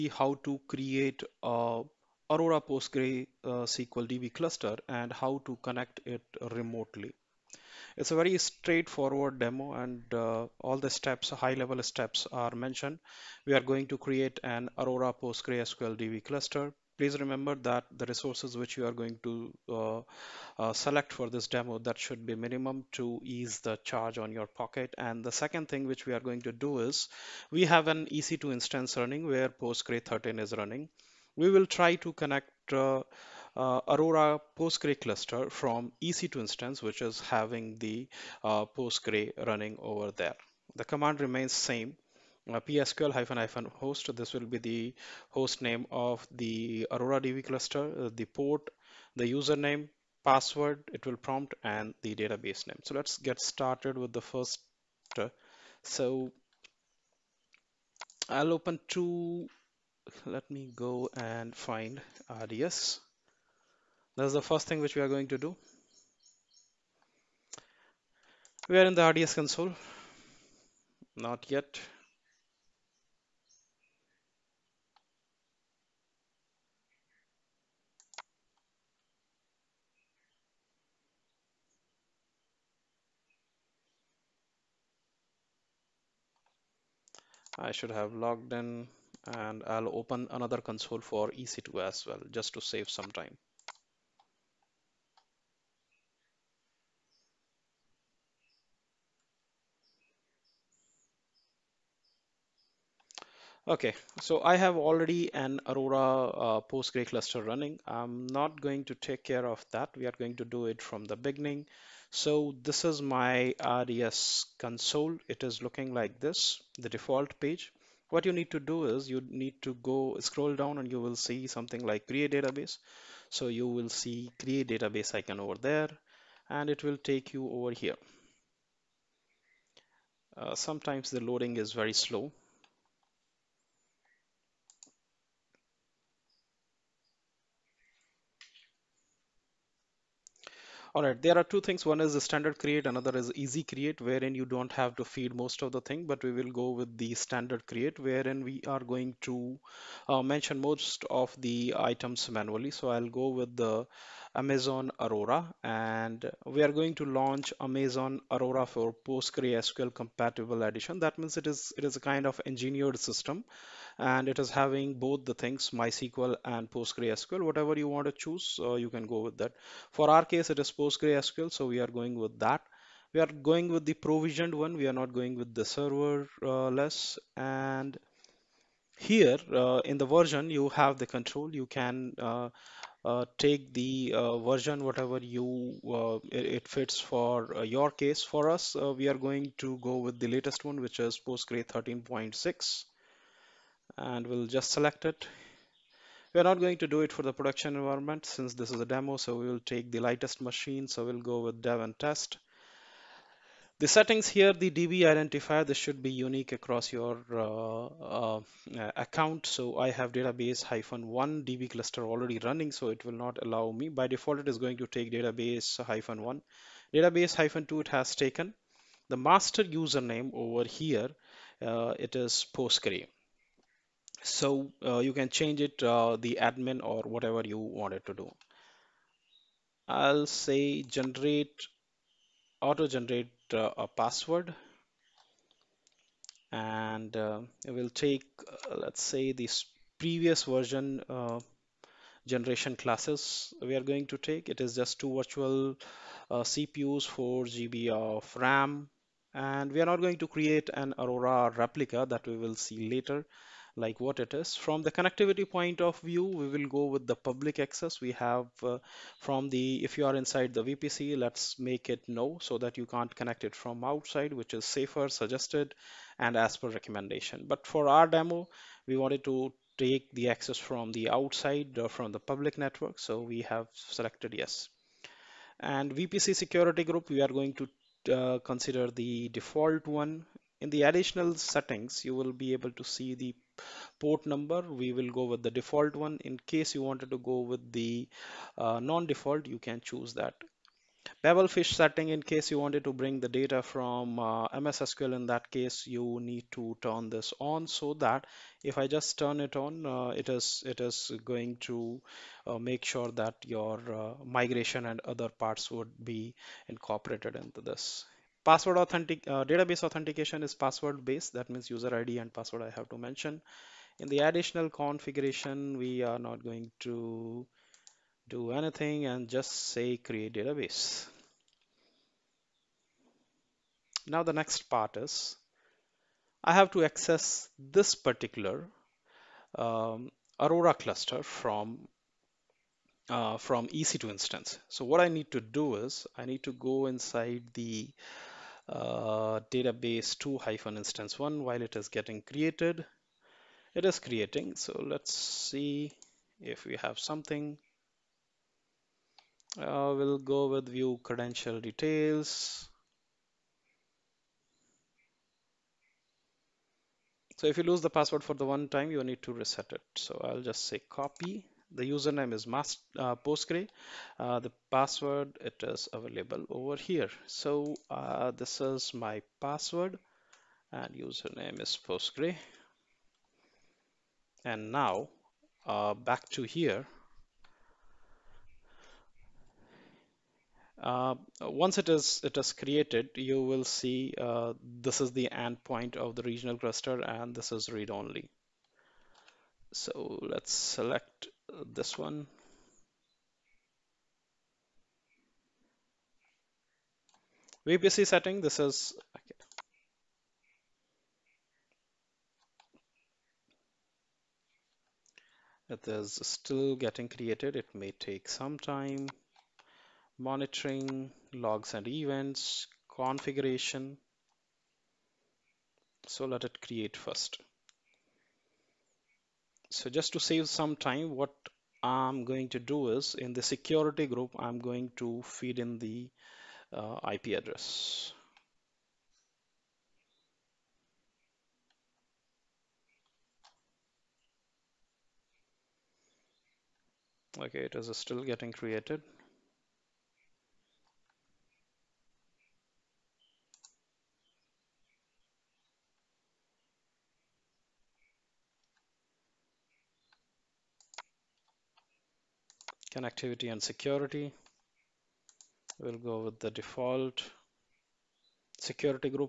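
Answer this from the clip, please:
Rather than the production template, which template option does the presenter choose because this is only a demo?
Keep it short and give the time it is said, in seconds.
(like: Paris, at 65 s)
Dev and test, at 201 s.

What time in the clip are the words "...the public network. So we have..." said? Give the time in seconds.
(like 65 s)
272 s.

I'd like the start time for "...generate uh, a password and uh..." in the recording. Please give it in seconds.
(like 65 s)
232 s.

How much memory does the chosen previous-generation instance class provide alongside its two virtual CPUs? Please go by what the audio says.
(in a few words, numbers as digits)
4 GB.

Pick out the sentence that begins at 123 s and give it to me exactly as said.
So you will see create database icon over there and it will take you over here.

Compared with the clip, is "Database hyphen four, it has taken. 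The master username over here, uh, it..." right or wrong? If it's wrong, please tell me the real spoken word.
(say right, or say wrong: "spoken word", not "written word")
wrong: "two", not "four".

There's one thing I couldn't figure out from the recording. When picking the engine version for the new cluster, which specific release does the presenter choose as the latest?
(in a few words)
13.6.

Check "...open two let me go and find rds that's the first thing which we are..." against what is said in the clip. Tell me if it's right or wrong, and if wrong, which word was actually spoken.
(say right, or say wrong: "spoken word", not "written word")
right.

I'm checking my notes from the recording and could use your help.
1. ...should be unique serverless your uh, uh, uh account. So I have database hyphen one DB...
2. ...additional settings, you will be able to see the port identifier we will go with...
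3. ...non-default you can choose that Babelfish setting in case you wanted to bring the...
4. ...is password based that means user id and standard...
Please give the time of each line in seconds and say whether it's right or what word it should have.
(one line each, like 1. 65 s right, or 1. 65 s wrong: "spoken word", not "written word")
1. 205 s wrong: "across", not "serverless"
2. 280 s wrong: "number", not "identifier"
3. 288 s right
4. 310 s wrong: "password", not "standard".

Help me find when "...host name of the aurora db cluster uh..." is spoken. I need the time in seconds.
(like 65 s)
45 s.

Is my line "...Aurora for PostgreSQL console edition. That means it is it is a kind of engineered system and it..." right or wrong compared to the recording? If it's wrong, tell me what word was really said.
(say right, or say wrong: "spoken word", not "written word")
wrong: "compatible", not "console".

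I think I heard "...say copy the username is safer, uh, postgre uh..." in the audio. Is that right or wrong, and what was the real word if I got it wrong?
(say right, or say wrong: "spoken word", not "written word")
wrong: "master", not "safer".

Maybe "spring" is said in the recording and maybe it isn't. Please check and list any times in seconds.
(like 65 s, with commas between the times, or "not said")
not said.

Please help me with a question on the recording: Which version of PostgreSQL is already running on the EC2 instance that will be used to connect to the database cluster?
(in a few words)
13.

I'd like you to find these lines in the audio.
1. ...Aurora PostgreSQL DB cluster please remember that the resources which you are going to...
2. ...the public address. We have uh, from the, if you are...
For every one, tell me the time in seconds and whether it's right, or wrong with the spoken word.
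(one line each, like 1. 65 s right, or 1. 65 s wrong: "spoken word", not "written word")
1. 14 s right
2. 257 s wrong: "access", not "address".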